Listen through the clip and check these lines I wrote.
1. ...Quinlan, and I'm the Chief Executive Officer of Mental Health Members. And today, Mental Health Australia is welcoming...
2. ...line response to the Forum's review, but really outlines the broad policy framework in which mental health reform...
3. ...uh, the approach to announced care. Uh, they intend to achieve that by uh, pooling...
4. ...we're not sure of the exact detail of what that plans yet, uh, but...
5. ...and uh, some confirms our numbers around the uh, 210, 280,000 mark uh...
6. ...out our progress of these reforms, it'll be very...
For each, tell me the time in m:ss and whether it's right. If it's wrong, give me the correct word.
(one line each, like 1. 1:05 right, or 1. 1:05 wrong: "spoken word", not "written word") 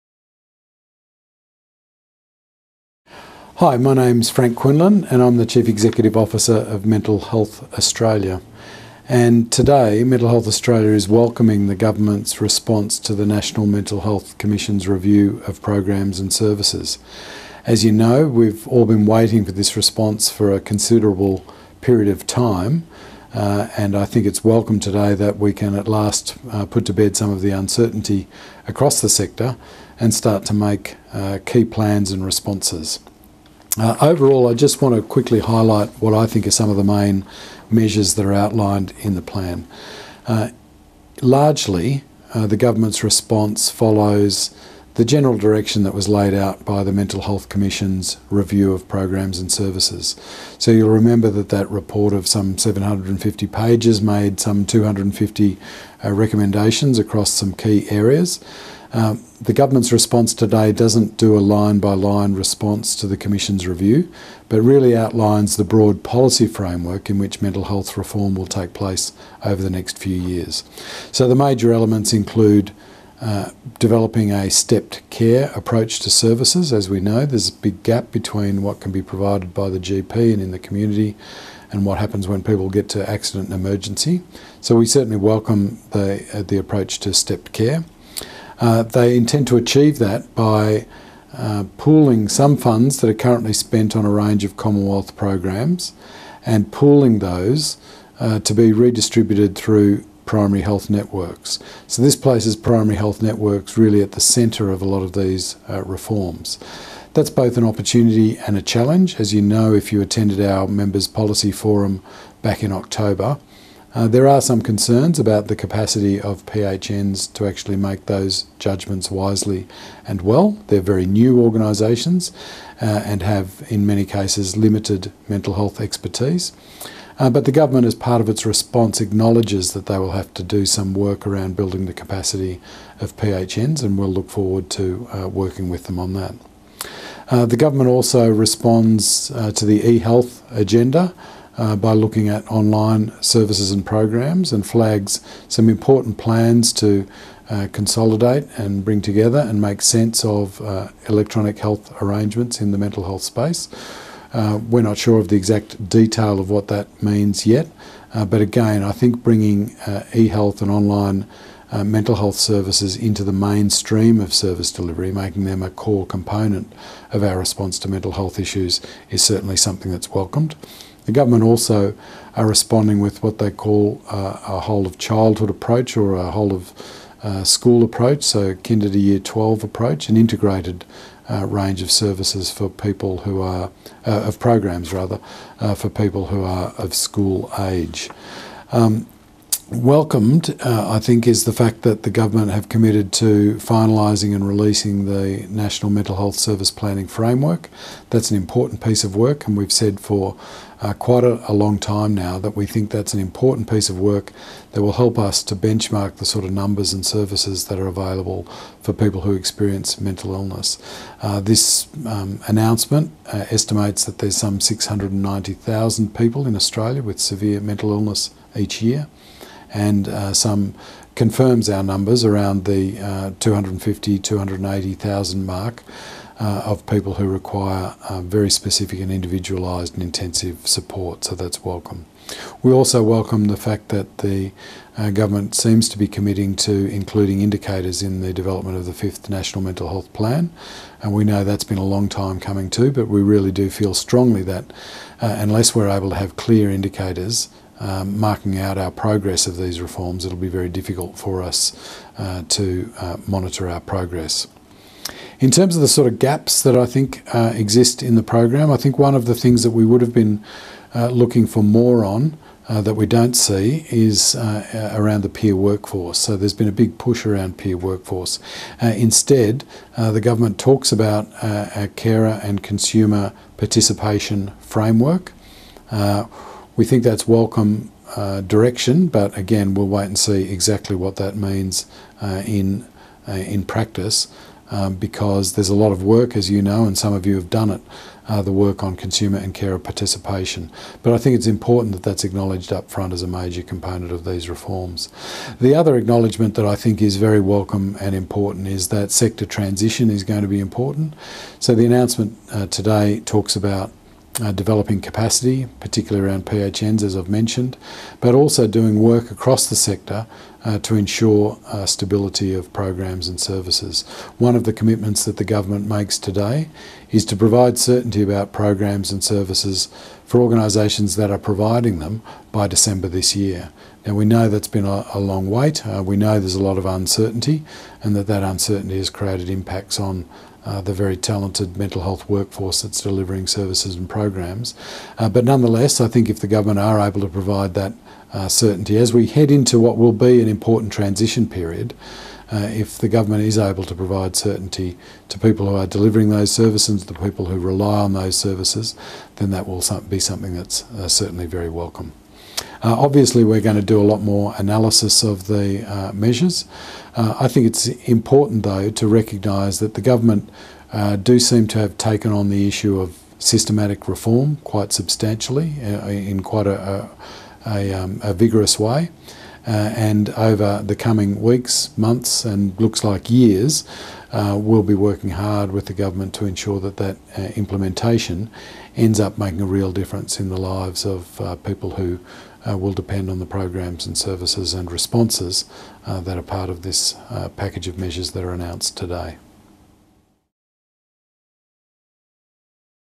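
1. 0:04 wrong: "Australia", not "Members"
2. 1:01 wrong: "Commission", not "Forum"
3. 1:26 wrong: "stepped", not "announced"
4. 2:34 wrong: "means", not "plans"
5. 3:39 wrong: "250", not "210"
6. 4:08 right.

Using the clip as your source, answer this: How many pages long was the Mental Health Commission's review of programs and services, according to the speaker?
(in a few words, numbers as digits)
750.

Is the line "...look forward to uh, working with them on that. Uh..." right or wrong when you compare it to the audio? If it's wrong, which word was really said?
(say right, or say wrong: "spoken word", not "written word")
right.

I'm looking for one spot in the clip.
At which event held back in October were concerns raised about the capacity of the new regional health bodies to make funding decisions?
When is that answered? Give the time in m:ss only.
1:50.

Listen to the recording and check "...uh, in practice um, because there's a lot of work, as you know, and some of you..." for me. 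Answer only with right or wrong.
right.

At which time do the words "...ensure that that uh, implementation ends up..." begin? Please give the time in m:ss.
6:16.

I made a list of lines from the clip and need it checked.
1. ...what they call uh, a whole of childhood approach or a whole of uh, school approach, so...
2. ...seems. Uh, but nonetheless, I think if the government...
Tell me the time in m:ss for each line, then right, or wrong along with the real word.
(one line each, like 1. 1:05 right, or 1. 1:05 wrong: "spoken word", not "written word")
1. 2:53 right
2. 5:34 wrong: "programs", not "seems".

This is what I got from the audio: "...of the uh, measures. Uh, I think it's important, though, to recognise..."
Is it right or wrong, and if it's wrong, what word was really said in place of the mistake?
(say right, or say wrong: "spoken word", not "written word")
right.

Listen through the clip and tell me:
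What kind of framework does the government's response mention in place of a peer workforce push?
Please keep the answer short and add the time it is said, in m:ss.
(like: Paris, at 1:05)
carer and consumer participation framework, at 4:31.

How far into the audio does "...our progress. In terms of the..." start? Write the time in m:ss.
4:13.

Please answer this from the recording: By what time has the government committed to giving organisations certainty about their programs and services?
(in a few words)
December this year.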